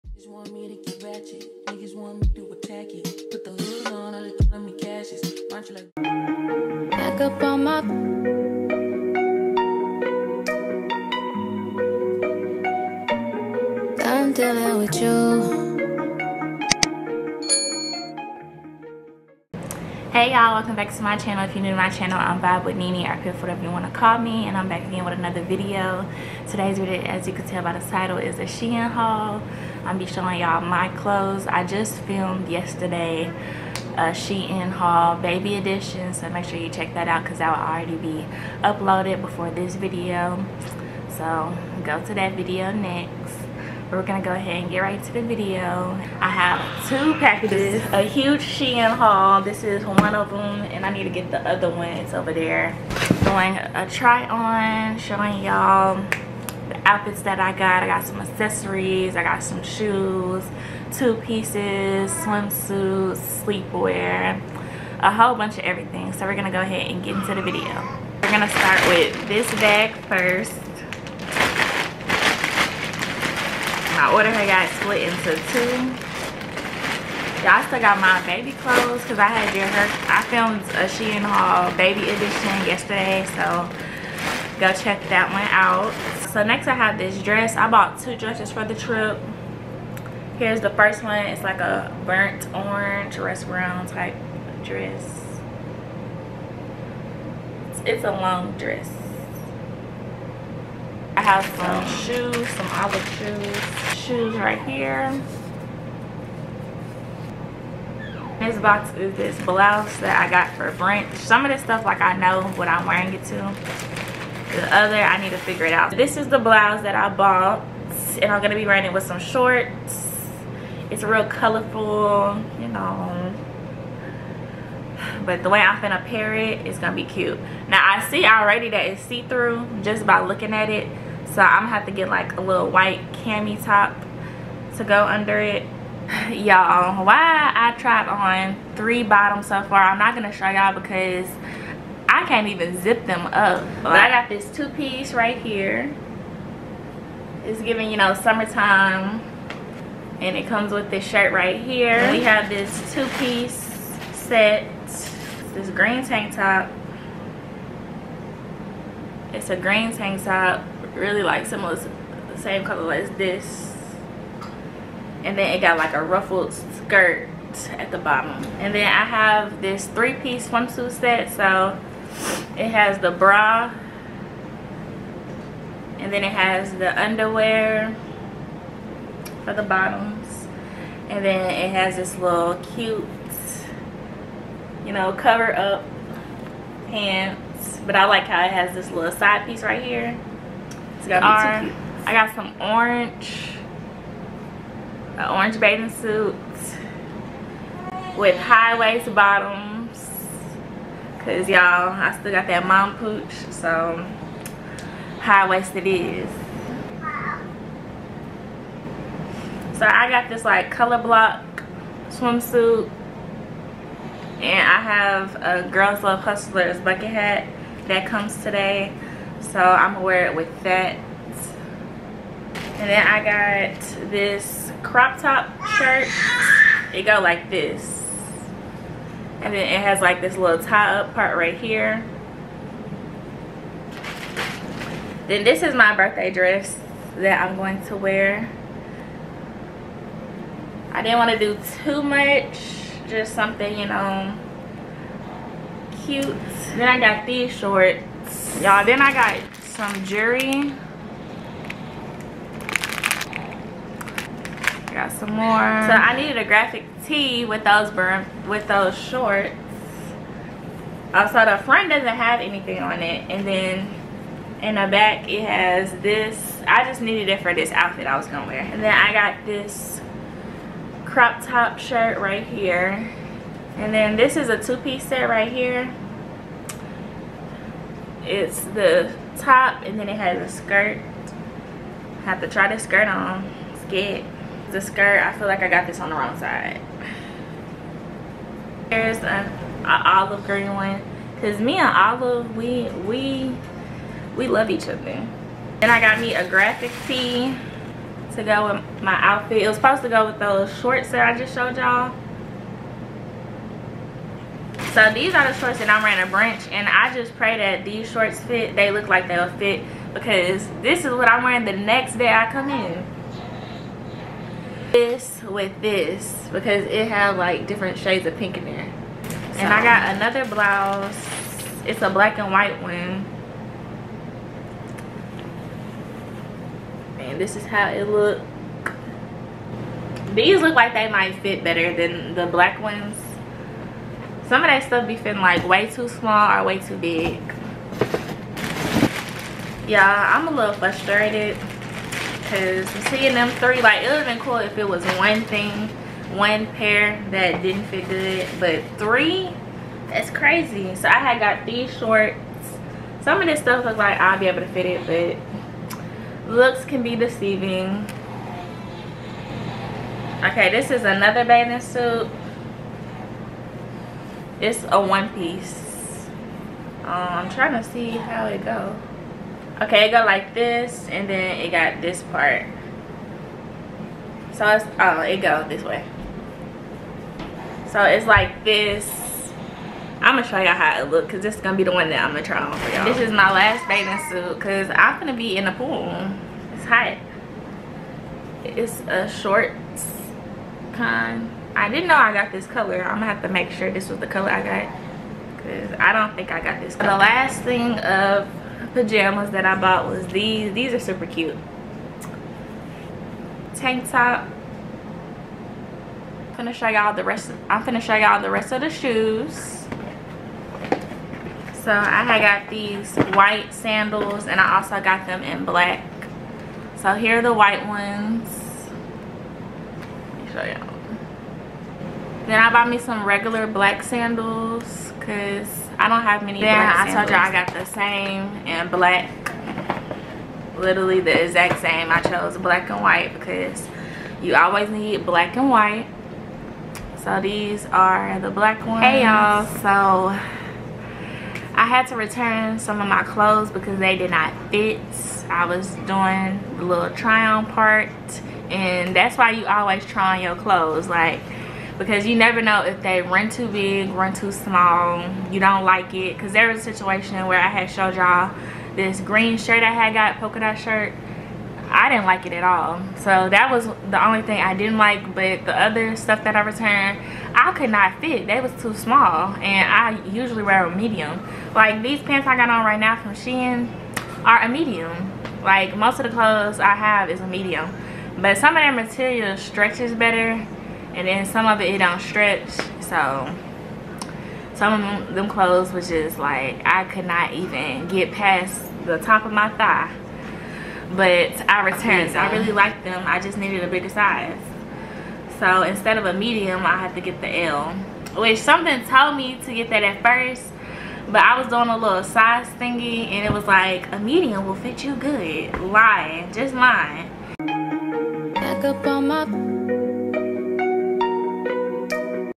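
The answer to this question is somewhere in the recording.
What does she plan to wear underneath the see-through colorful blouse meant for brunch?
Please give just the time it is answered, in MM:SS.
02:12.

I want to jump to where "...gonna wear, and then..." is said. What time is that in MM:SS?
04:28.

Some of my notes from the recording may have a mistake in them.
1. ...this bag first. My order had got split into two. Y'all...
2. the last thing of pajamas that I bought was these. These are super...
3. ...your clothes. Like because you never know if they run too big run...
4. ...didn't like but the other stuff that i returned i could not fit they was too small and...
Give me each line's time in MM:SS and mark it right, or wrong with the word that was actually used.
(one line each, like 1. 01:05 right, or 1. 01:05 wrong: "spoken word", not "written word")
1. 01:09 right
2. 06:37 right
3. 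07:30 right
4. 07:44 right.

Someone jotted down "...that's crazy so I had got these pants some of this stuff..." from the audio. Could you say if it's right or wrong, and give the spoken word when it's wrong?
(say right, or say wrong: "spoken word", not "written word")
wrong: "shorts", not "pants".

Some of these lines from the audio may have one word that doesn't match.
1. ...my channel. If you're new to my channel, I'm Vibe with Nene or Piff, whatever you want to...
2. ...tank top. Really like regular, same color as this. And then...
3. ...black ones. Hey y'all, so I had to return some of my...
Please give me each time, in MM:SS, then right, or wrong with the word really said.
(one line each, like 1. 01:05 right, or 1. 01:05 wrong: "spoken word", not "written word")
1. 00:21 right
2. 02:39 wrong: "similar", not "regular"
3. 07:18 right.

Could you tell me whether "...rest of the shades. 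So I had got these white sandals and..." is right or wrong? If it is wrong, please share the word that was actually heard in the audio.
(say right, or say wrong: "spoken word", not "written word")
wrong: "shoes", not "shades".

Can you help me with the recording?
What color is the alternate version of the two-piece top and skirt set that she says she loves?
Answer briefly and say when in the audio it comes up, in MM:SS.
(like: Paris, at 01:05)
olive green, at 04:49.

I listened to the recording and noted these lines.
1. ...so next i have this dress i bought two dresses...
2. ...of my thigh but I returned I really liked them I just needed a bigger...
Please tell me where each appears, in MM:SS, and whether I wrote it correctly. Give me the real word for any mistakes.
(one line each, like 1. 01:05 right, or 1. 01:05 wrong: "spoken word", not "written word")
1. 01:26 right
2. 08:09 right.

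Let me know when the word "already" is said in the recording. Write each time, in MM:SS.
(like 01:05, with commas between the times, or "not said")
00:37, 02:08.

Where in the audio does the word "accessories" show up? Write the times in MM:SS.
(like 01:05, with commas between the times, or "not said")
00:58.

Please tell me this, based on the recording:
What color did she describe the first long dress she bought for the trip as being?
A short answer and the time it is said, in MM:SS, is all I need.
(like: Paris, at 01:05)
burnt orange, at 01:32.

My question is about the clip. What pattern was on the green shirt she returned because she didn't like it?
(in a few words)
polka dot.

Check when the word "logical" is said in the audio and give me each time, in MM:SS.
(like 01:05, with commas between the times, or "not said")
not said.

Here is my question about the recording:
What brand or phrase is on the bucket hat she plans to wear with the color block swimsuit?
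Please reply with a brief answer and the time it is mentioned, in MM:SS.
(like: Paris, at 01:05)
Girls Love Hustlers, at 03:35.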